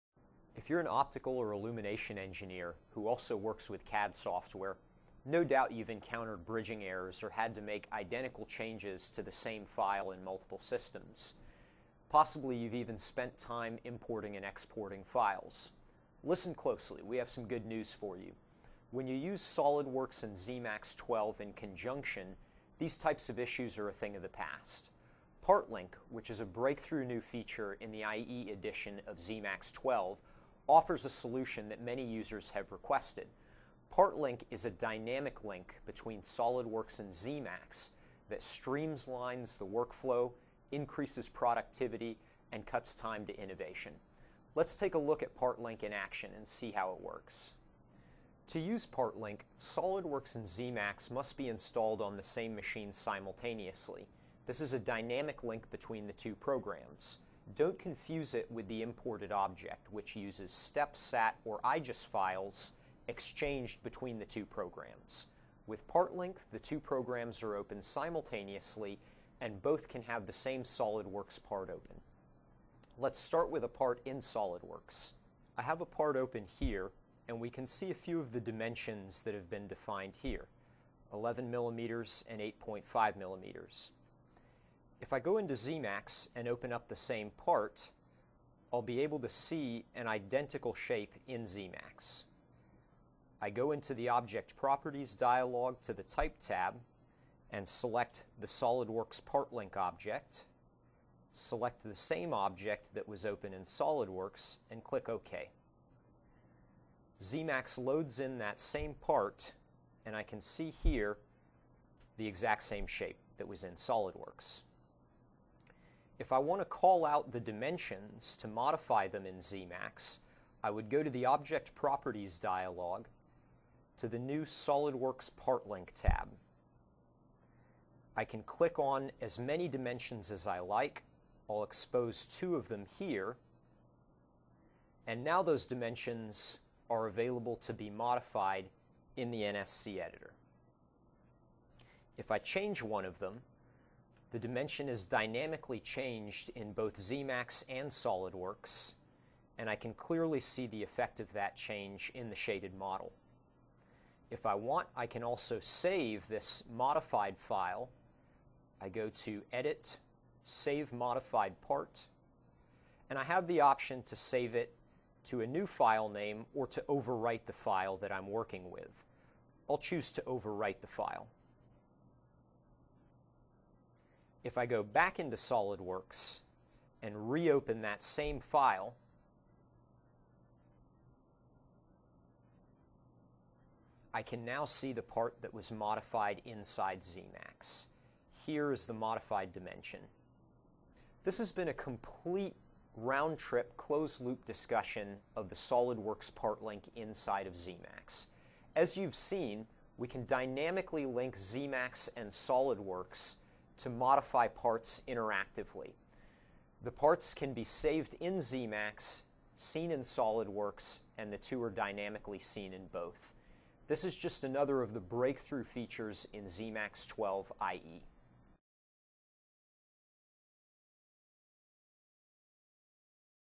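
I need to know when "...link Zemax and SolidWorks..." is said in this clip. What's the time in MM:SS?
03:21.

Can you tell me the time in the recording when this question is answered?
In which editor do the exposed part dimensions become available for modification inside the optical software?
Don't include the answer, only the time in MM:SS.
02:19.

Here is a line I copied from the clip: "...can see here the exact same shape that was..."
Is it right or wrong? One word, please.
right.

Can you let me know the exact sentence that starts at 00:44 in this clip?
Let's take a look at Partlink in action and see how it works.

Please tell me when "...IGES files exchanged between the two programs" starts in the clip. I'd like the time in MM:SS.
01:01.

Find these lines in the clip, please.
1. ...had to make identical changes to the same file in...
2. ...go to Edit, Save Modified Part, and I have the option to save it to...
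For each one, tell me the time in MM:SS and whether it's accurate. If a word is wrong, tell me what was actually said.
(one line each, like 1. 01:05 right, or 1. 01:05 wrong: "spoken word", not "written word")
1. 00:07 right
2. 02:38 right.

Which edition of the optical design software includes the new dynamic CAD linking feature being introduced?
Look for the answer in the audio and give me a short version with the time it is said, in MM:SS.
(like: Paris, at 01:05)
IE edition, at 00:28.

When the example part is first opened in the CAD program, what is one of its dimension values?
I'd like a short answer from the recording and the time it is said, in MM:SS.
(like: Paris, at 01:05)
11 millimeters, at 01:21.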